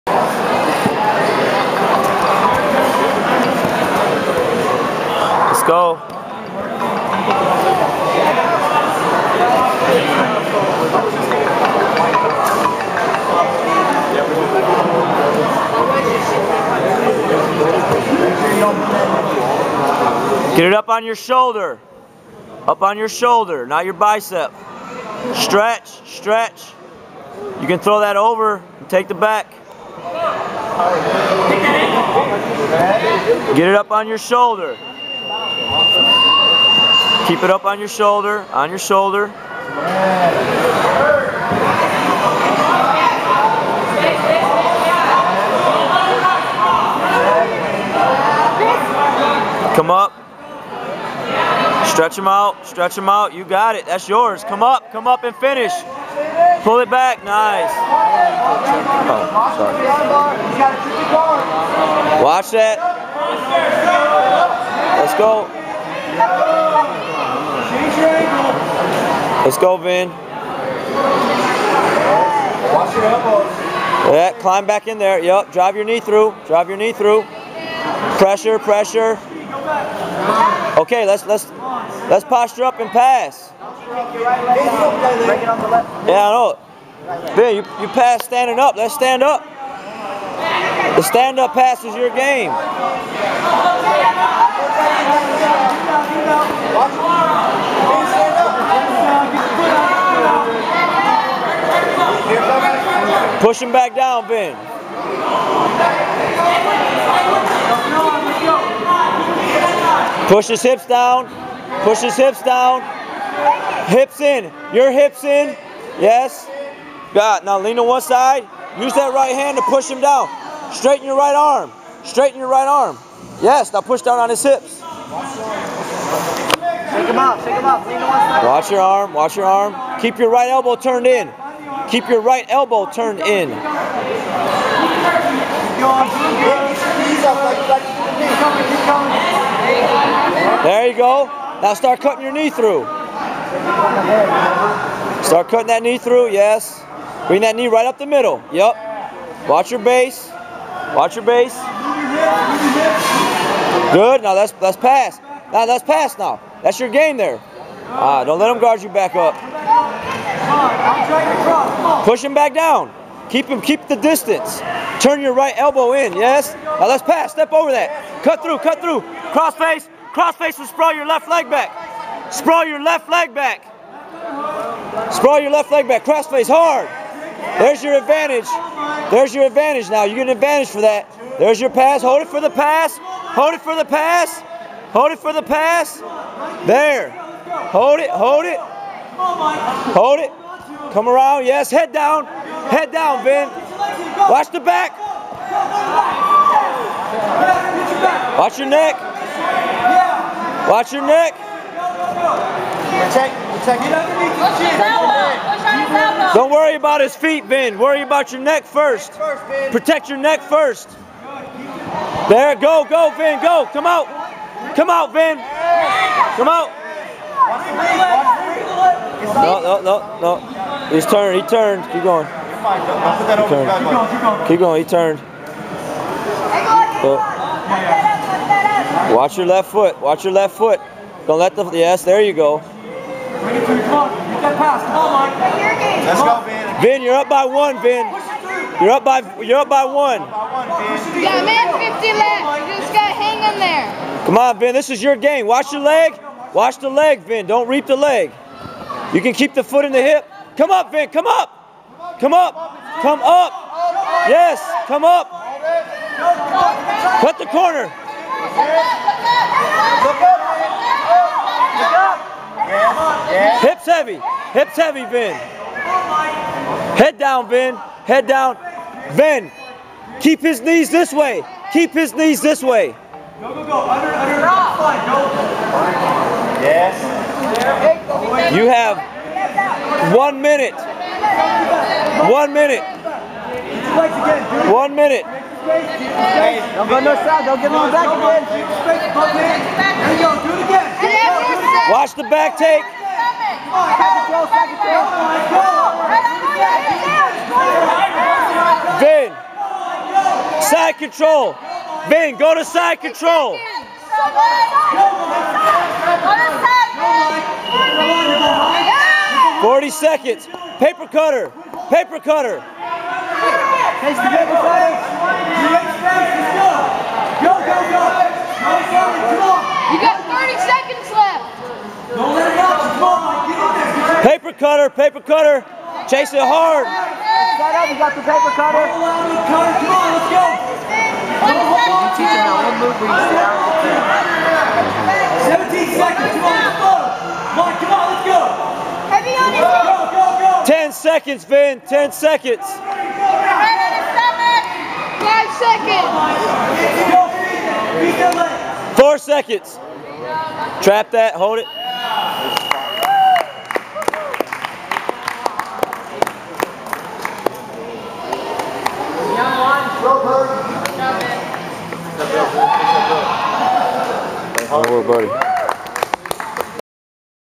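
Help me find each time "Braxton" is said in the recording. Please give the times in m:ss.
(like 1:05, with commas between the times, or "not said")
not said.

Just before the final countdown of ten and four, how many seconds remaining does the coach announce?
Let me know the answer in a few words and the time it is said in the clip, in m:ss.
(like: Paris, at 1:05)
17, at 5:35.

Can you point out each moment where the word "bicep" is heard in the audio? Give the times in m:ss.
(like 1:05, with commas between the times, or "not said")
0:23.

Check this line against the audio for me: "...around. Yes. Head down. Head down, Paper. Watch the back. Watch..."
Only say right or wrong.
wrong.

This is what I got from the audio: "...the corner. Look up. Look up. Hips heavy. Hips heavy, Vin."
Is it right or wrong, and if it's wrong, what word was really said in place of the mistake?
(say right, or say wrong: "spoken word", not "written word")
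right.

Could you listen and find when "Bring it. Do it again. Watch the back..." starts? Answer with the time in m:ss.
4:48.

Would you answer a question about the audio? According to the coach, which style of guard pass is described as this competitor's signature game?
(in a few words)
Stand-up pass.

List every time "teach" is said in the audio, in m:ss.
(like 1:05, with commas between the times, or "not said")
5:32.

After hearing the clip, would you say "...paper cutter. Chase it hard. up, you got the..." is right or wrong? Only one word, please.
right.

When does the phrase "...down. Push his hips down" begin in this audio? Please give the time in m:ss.
1:50.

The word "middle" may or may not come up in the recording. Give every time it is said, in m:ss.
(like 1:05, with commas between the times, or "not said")
2:28.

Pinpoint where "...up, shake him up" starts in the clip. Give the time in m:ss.
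2:07.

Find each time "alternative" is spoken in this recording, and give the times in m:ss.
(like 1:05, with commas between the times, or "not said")
not said.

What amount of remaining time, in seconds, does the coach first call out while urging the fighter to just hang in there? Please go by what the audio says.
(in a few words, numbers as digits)
50.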